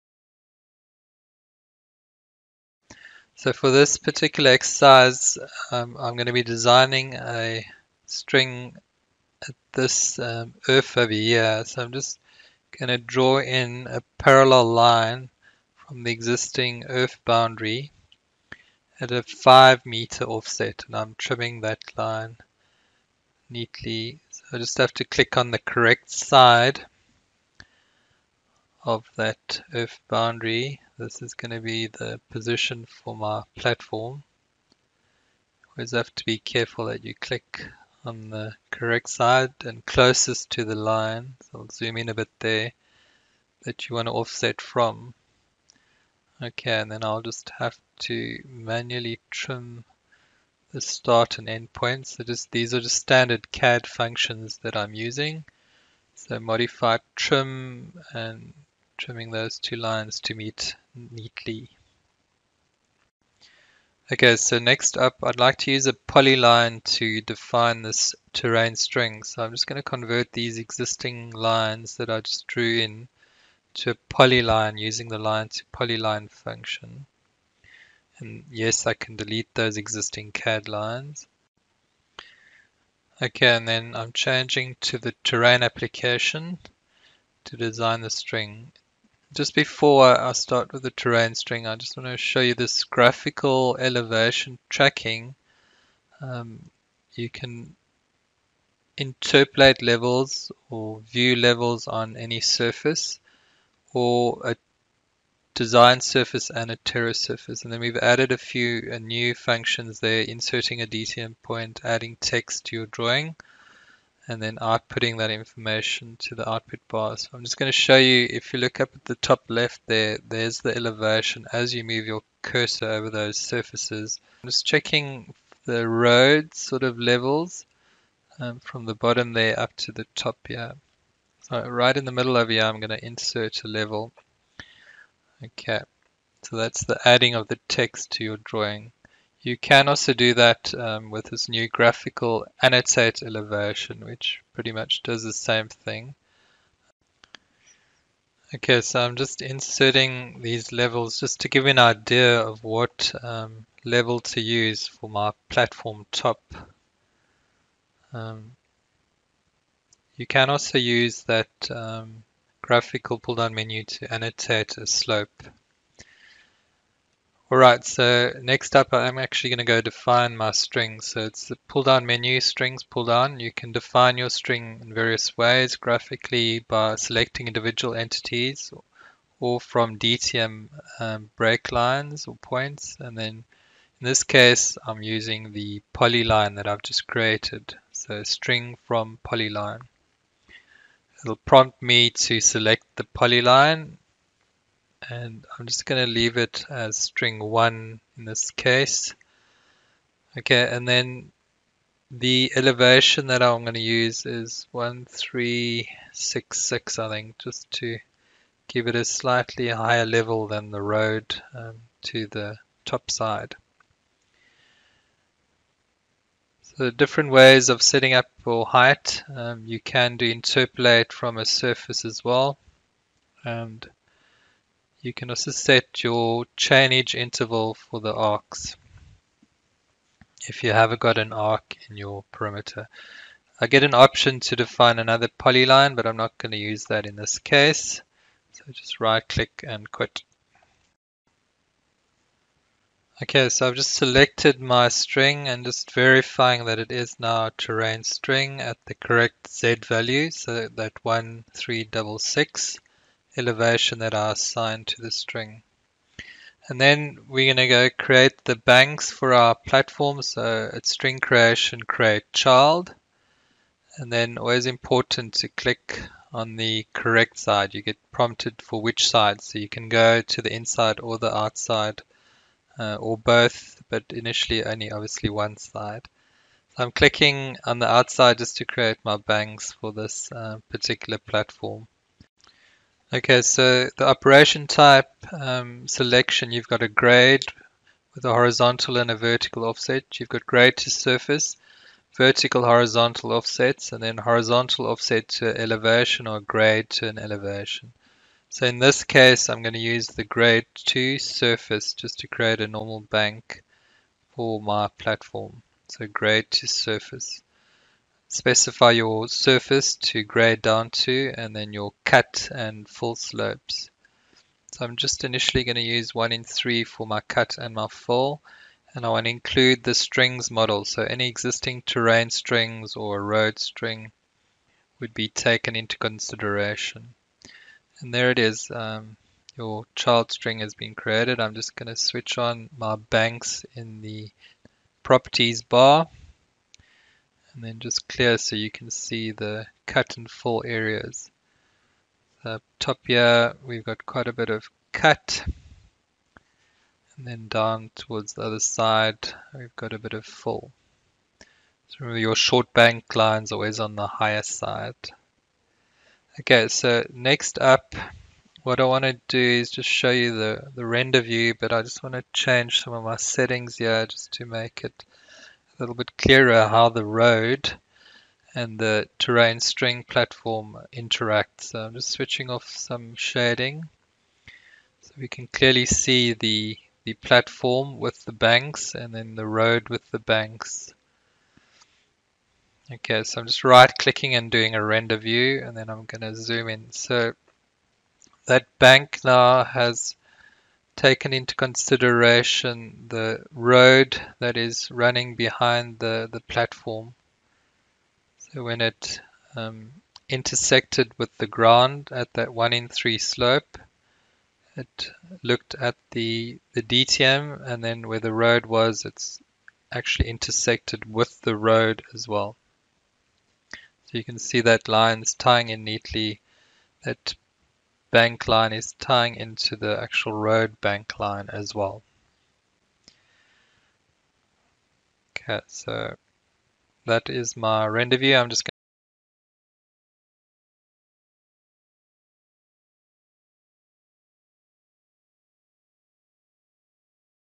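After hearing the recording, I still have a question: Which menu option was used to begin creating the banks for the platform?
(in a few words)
create child.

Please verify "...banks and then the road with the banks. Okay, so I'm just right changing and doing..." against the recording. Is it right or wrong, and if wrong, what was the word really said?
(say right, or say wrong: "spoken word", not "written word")
wrong: "clicking", not "changing".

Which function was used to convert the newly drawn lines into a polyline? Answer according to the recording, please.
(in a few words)
line to polyline.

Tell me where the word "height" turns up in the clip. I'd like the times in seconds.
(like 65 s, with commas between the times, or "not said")
218 s.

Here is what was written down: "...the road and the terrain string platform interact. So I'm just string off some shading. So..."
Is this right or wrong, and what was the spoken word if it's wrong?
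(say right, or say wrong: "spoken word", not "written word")
wrong: "switching", not "string".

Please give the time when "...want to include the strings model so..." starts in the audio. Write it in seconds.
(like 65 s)
319 s.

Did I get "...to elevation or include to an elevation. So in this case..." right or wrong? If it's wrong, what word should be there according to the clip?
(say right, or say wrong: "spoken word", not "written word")
wrong: "grade", not "include".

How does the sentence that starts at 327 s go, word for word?
And there it is, um, your child string has been created.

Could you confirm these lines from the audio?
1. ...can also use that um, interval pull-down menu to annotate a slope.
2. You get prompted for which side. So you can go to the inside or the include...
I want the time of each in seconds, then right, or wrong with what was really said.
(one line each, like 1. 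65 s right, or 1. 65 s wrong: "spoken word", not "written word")
1. 160 s wrong: "graphical", not "interval"
2. 267 s wrong: "outside", not "include".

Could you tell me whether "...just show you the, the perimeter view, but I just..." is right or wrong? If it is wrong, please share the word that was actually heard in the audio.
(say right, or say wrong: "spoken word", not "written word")
wrong: "render", not "perimeter".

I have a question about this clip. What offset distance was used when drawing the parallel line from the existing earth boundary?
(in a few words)
5 meters.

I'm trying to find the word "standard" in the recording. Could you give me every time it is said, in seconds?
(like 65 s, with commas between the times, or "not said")
52 s.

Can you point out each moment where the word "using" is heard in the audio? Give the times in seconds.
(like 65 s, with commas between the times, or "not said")
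54 s, 74 s, 185 s.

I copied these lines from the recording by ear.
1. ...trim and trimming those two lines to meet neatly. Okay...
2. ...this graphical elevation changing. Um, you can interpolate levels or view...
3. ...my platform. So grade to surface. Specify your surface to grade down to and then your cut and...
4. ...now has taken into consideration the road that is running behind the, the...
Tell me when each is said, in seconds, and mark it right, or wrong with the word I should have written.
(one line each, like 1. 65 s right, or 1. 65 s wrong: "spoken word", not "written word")
1. 57 s right
2. 92 s wrong: "tracking", not "changing"
3. 304 s right
4. 389 s right.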